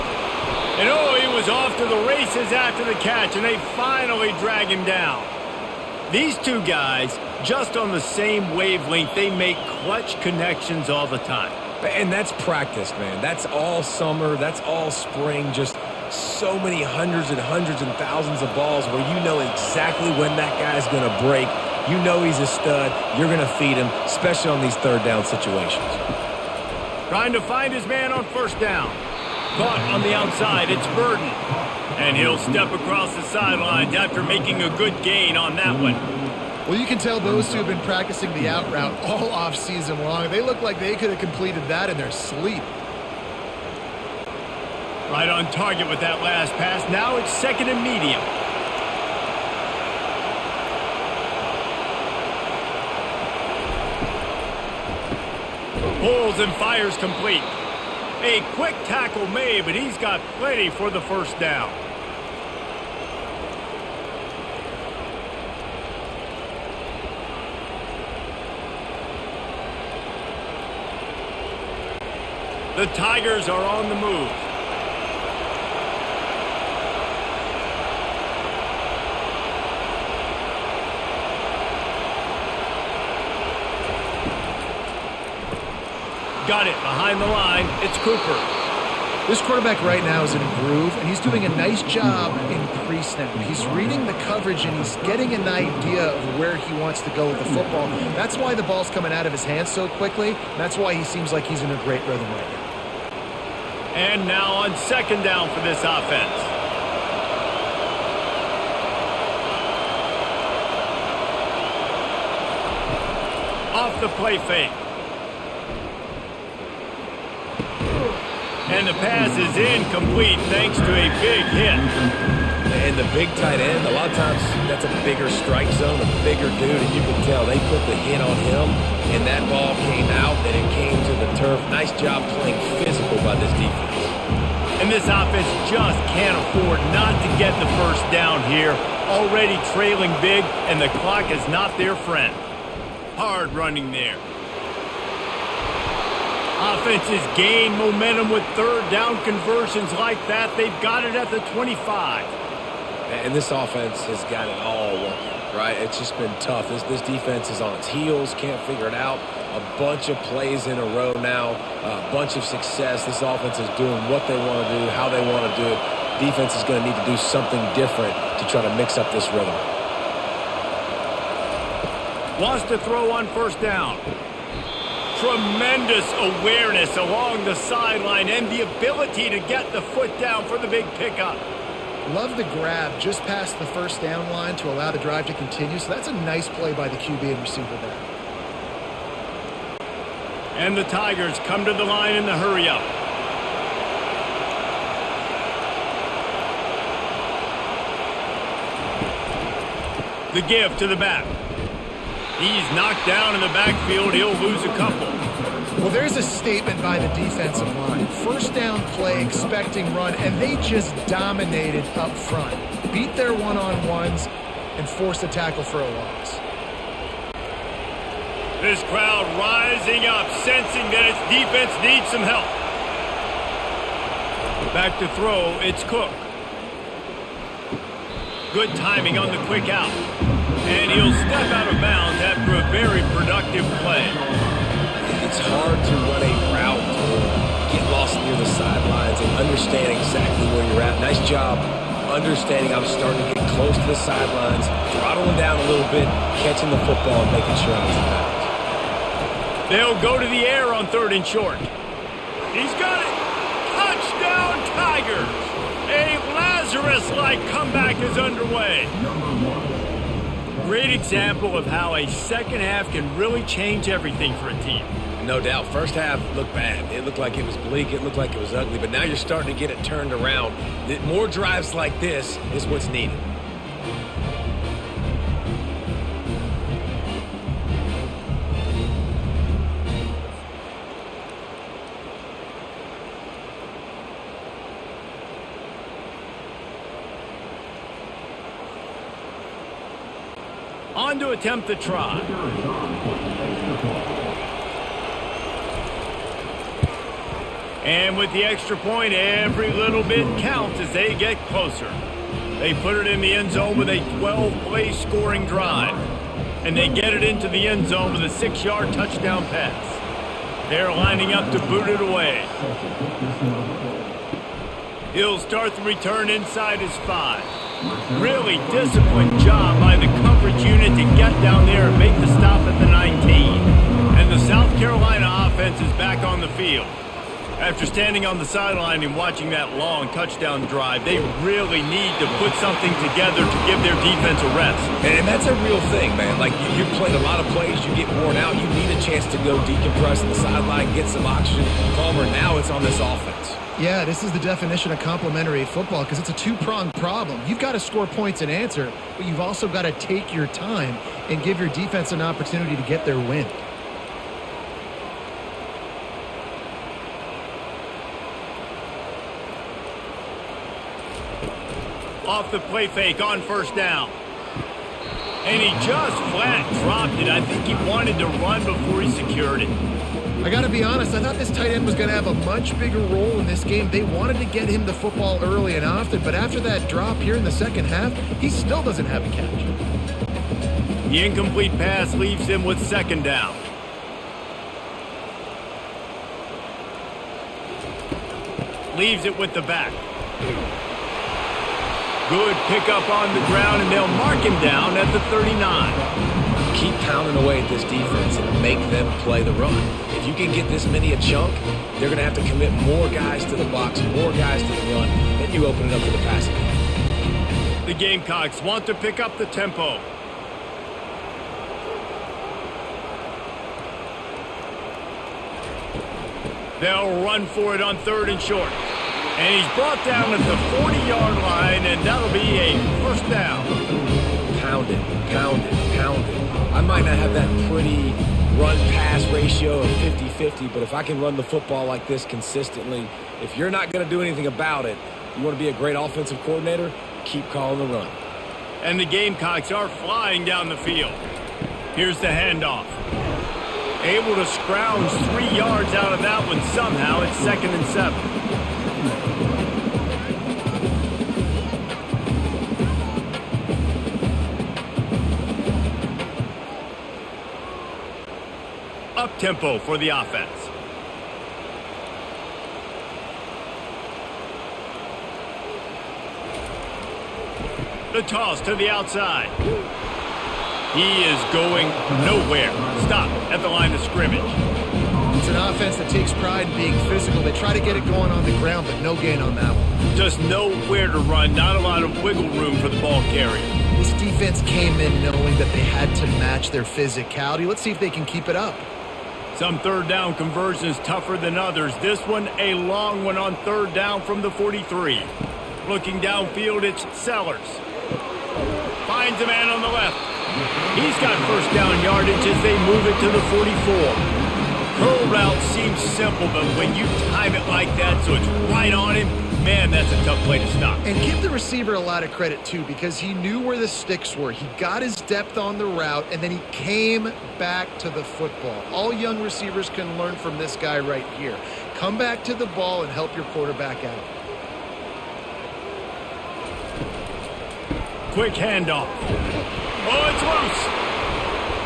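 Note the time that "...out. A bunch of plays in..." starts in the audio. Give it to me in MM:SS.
02:38.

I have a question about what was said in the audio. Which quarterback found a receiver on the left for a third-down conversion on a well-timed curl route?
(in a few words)
Sellers.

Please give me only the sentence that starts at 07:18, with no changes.
And the Gamecocks are flying down the field.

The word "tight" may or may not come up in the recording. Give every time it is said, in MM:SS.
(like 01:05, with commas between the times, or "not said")
02:03, 06:11.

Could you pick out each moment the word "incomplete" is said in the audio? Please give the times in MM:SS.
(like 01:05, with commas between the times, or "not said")
01:59, 06:21.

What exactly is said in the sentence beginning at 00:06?
These two guys, just on the same wavelength, they make clutch connections all the time.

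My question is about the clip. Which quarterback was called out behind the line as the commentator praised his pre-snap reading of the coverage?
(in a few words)
Cooper.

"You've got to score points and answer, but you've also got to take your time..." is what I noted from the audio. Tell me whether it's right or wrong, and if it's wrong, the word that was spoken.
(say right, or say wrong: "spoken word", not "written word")
right.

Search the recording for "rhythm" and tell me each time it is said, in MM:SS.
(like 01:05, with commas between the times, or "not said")
01:42, 02:49.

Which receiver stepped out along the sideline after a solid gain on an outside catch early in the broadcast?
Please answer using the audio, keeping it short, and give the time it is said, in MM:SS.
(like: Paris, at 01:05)
Burden, at 00:30.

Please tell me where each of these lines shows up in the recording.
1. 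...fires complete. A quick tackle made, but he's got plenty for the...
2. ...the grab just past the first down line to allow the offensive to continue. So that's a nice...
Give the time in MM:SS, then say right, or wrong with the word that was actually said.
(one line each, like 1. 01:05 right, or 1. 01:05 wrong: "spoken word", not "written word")
1. 00:56 right
2. 03:02 wrong: "drive", not "offensive".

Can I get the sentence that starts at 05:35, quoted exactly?
And that's a real thing, man.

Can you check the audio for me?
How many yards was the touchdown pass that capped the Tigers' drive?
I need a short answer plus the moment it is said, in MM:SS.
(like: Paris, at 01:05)
6, at 05:08.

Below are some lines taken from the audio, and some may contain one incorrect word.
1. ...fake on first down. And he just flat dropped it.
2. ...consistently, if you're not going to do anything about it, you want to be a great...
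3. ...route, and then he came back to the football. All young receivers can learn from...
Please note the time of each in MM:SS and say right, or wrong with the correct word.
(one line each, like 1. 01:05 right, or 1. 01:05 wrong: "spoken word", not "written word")
1. 06:02 right
2. 07:12 right
3. 08:35 right.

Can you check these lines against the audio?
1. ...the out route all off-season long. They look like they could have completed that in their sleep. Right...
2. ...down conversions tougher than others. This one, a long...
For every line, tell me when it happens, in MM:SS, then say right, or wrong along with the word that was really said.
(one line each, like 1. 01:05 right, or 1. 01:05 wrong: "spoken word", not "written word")
1. 00:38 right
2. 08:10 right.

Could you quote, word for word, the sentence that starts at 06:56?
They'll run for it on third and short.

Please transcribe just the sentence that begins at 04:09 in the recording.
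They'll go to the air on third and short.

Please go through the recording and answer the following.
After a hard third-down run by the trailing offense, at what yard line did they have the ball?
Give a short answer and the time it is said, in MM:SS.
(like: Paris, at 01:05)
25, at 02:31.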